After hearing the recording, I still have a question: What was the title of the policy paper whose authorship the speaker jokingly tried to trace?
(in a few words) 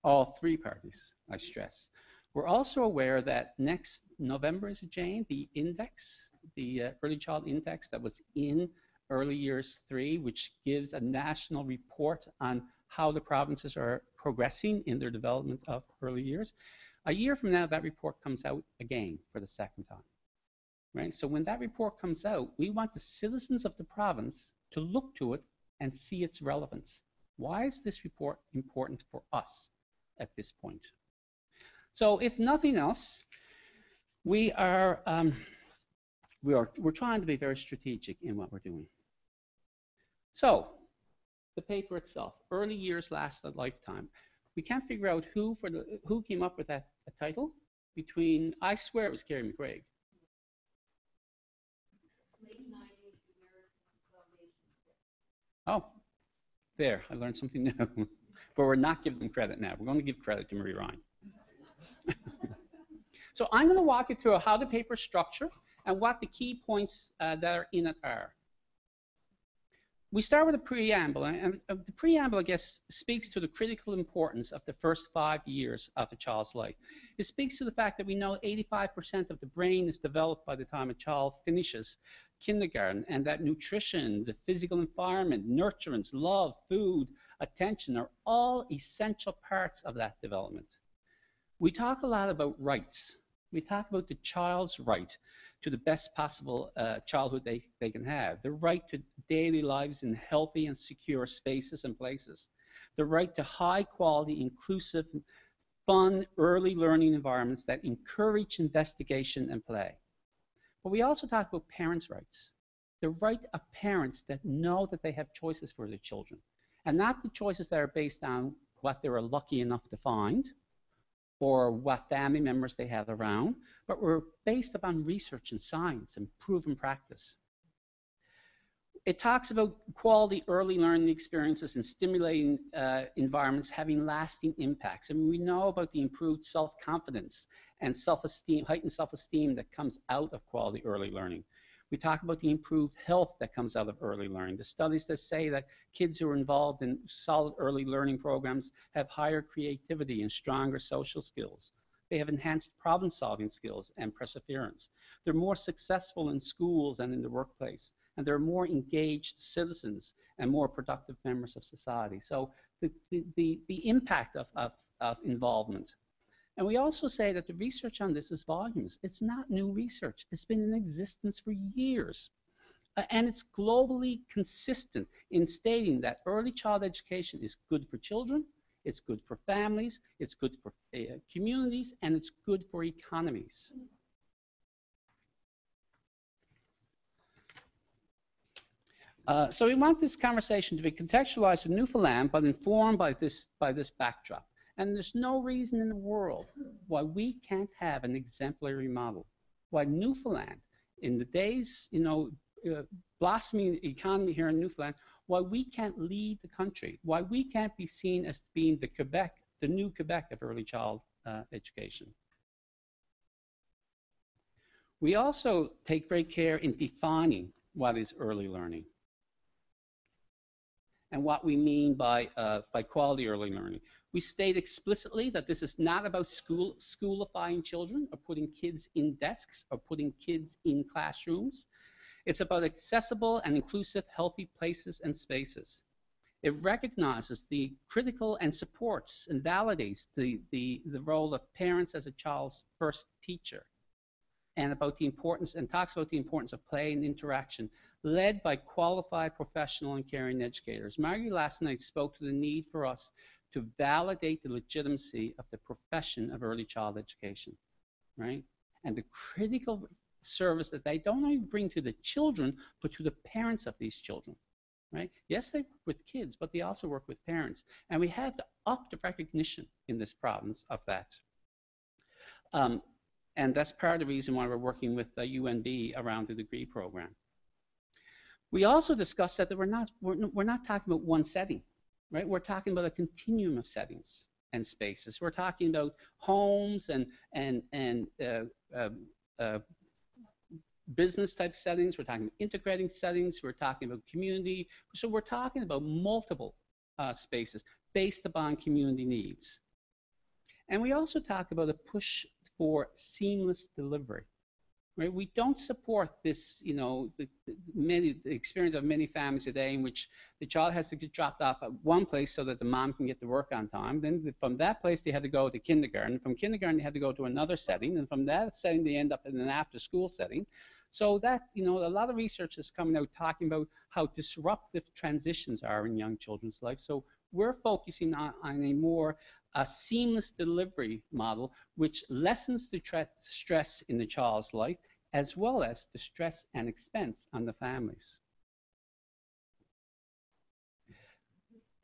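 Early Years Last a Lifetime.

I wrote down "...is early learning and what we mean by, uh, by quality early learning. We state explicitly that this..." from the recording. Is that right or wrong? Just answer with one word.
right.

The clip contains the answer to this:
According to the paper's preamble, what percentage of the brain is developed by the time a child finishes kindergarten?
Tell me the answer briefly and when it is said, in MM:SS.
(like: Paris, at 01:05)
85%, at 01:18.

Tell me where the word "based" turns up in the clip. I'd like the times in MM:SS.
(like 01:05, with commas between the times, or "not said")
01:57, 02:04, 04:57.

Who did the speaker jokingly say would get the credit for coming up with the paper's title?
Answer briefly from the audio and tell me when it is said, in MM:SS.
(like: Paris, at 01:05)
Marie Ryan, at 01:00.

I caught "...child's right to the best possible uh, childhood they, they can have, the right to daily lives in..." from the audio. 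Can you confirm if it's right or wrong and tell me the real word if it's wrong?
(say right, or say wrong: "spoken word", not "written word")
right.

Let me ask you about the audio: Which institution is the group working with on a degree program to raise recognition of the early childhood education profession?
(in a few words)
UNB.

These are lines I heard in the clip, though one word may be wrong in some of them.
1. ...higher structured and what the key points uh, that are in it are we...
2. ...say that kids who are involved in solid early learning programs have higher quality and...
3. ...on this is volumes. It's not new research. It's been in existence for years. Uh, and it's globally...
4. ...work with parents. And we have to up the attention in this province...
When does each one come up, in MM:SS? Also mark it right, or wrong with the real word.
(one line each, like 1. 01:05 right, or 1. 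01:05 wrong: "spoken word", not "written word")
1. 01:04 wrong: "paper", not "higher"
2. 02:25 wrong: "creativity", not "quality"
3. 02:48 right
4. 04:26 wrong: "recognition", not "attention".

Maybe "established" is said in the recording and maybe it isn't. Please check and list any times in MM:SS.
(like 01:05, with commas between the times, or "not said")
not said.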